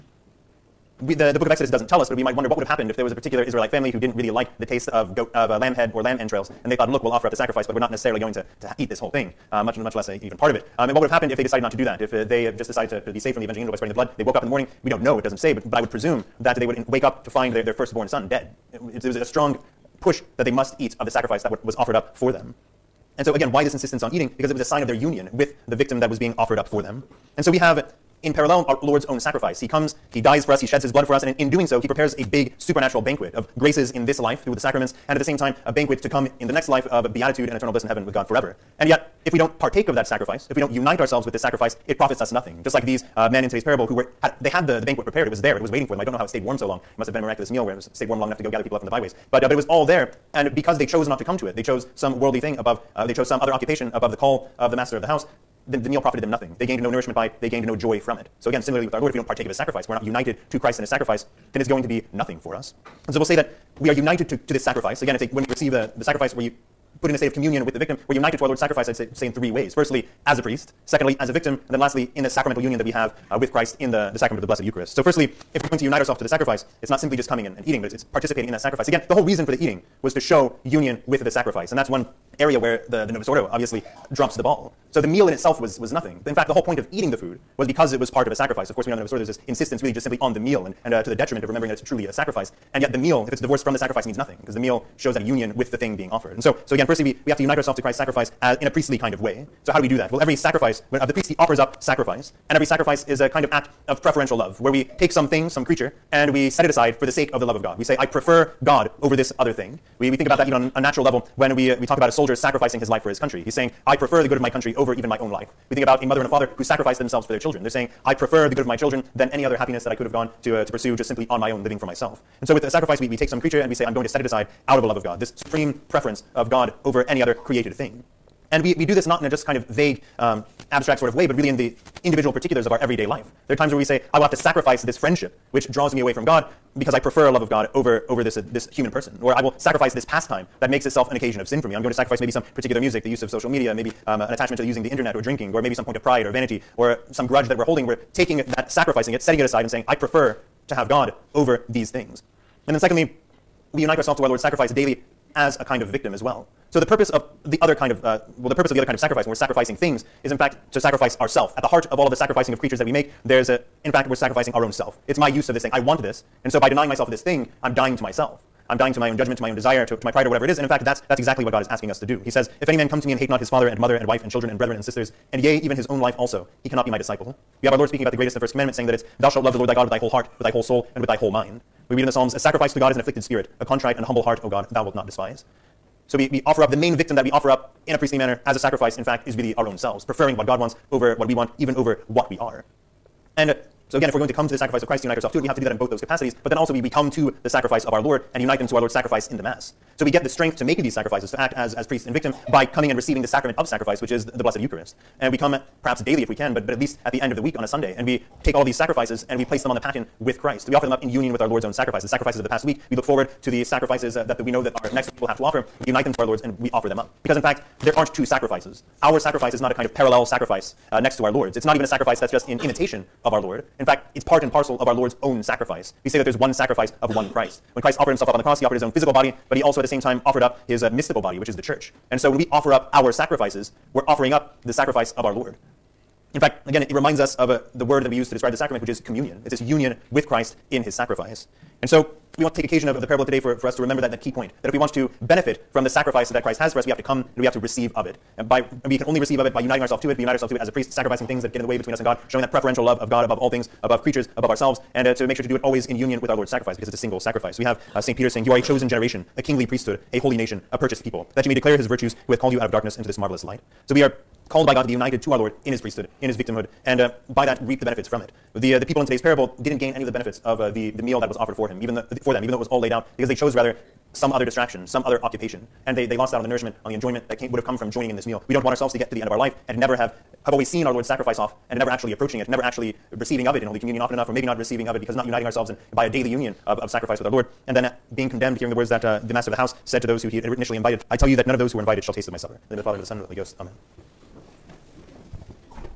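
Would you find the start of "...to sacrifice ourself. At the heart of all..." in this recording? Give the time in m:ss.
2:40.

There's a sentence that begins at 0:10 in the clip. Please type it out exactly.
Um, and what would have happened if they decided not to do that?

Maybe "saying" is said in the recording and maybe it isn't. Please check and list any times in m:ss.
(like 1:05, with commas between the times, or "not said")
1:53, 1:57, 2:29, 2:58, 4:18.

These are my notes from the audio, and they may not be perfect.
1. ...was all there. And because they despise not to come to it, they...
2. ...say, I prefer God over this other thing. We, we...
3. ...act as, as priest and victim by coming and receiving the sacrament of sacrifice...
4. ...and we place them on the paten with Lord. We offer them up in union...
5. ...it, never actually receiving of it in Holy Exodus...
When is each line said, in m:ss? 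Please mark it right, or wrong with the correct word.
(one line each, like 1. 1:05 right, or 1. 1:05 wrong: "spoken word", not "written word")
1. 0:49 wrong: "chose", not "despise"
2. 1:47 right
3. 3:21 right
4. 3:29 wrong: "Christ", not "Lord"
5. 4:42 wrong: "Communion", not "Exodus".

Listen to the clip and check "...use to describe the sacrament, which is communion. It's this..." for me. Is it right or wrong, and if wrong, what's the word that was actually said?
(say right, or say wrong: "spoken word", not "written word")
right.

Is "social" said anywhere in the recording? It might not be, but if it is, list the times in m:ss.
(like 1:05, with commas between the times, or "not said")
2:23.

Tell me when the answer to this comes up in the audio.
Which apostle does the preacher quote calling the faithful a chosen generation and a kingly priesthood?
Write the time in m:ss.
4:18.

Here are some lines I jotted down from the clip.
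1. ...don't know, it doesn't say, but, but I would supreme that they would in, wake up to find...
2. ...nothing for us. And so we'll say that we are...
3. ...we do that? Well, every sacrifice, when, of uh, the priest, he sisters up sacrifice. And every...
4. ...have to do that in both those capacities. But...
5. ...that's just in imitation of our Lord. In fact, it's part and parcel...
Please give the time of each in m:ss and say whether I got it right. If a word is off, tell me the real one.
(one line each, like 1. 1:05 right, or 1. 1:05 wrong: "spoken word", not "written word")
1. 0:14 wrong: "presume", not "supreme"
2. 1:02 right
3. 1:39 wrong: "offers", not "sisters"
4. 3:15 right
5. 3:42 right.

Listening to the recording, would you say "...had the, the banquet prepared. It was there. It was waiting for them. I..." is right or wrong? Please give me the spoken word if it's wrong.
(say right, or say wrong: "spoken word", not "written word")
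right.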